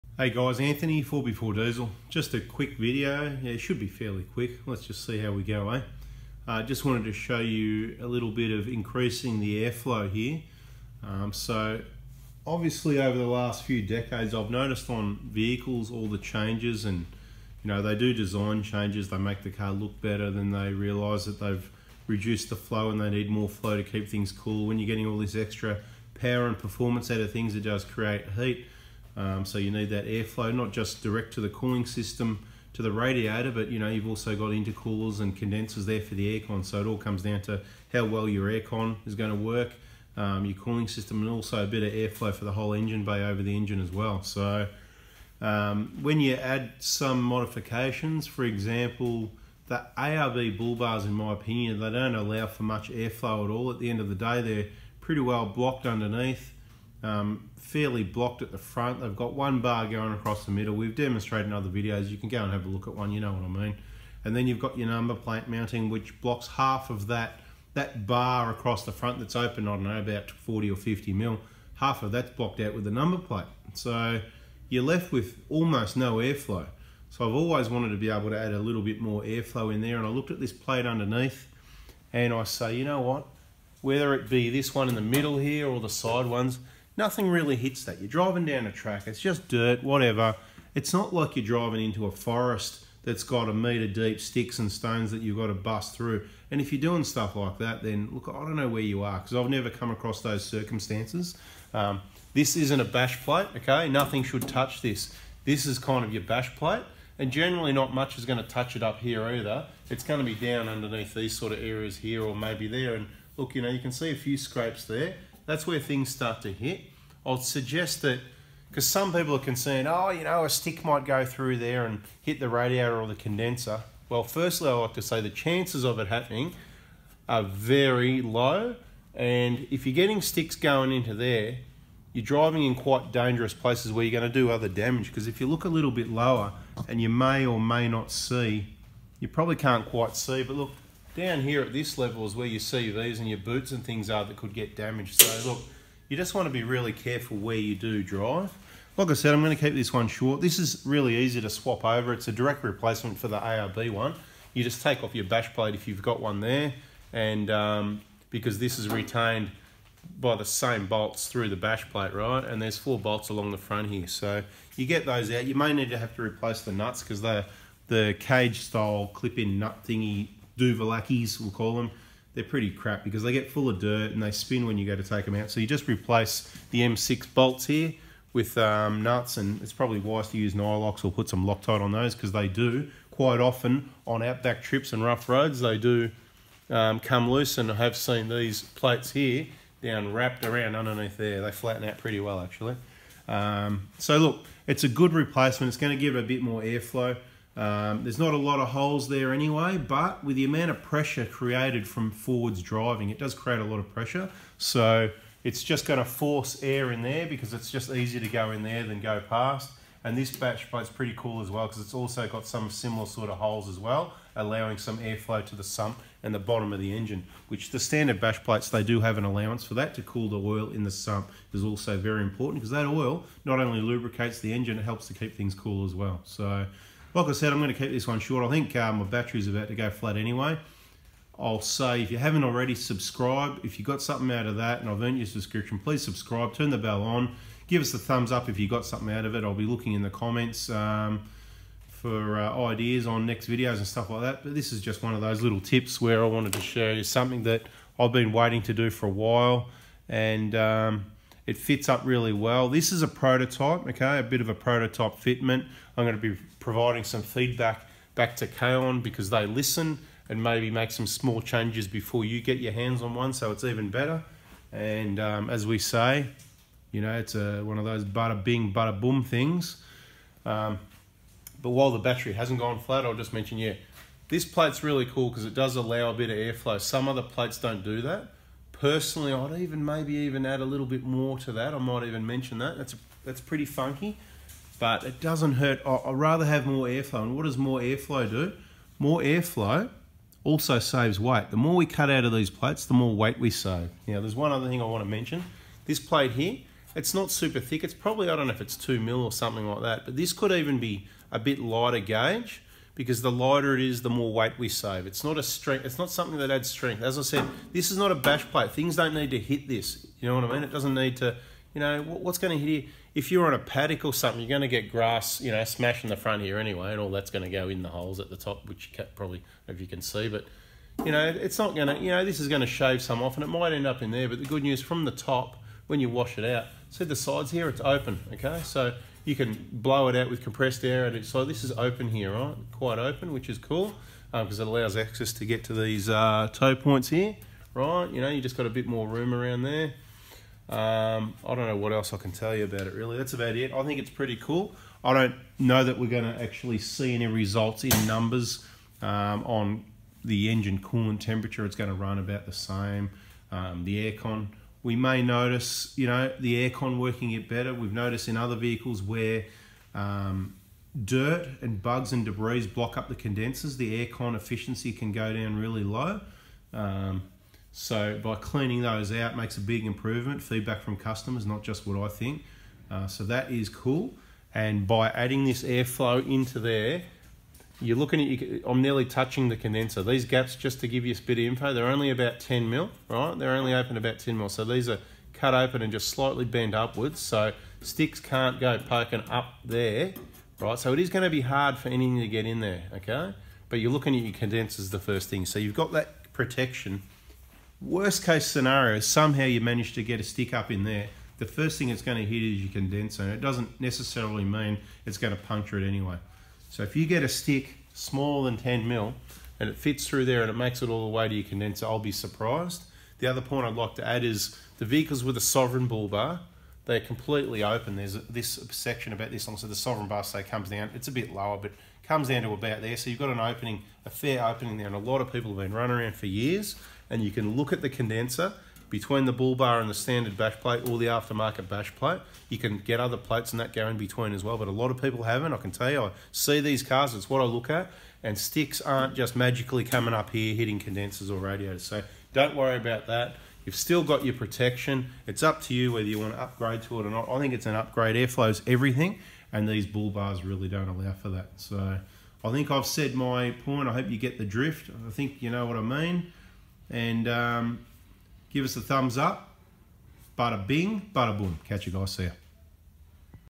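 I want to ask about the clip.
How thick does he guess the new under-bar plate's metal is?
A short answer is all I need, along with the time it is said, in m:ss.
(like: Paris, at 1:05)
2 mm, at 4:58.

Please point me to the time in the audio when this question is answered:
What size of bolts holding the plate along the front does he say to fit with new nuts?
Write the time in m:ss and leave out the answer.
2:56.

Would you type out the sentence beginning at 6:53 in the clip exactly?
The other point I'd like to add is the vehicles with a sovereign bull bar, they're completely open.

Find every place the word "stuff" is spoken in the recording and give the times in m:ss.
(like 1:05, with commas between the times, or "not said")
1:37, 4:03.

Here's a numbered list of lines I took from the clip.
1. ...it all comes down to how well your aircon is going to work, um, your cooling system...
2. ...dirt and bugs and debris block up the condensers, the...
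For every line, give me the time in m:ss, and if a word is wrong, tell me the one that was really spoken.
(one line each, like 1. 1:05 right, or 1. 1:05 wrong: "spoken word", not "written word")
1. 0:36 right
2. 6:01 right.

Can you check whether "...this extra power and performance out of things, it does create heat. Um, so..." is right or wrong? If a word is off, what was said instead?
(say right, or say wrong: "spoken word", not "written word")
right.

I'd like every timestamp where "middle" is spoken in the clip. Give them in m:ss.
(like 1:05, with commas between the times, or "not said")
1:00, 1:25.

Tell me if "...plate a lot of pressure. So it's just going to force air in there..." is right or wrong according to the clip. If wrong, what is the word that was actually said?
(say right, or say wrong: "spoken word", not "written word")
wrong: "create", not "plate".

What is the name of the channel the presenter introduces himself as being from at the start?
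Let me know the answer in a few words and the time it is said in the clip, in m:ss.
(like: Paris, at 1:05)
Fourby4Diesel, at 0:01.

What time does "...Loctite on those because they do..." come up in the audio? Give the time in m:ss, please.
3:01.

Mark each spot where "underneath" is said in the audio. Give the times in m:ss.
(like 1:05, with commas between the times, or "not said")
0:55, 1:20, 1:50, 3:10.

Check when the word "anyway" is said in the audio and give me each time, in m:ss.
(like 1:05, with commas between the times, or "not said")
3:19, 3:50, 5:16, 6:45.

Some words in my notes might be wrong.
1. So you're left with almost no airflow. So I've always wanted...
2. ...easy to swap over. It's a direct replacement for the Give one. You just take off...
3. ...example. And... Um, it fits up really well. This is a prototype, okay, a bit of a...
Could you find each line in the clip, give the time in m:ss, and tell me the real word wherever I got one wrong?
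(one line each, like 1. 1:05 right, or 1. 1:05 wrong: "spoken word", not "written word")
1. 1:13 right
2. 2:31 wrong: "ARB", not "Give"
3. 4:09 wrong: "while", not "example".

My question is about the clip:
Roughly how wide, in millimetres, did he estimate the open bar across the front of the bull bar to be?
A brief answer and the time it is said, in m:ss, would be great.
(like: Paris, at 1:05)
40 or 50 mm, at 1:10.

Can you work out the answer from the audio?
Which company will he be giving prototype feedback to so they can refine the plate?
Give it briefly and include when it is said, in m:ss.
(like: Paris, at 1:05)
Kaon, at 4:18.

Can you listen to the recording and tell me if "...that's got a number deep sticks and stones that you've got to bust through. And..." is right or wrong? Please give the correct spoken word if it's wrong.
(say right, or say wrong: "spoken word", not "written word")
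wrong: "meter", not "number".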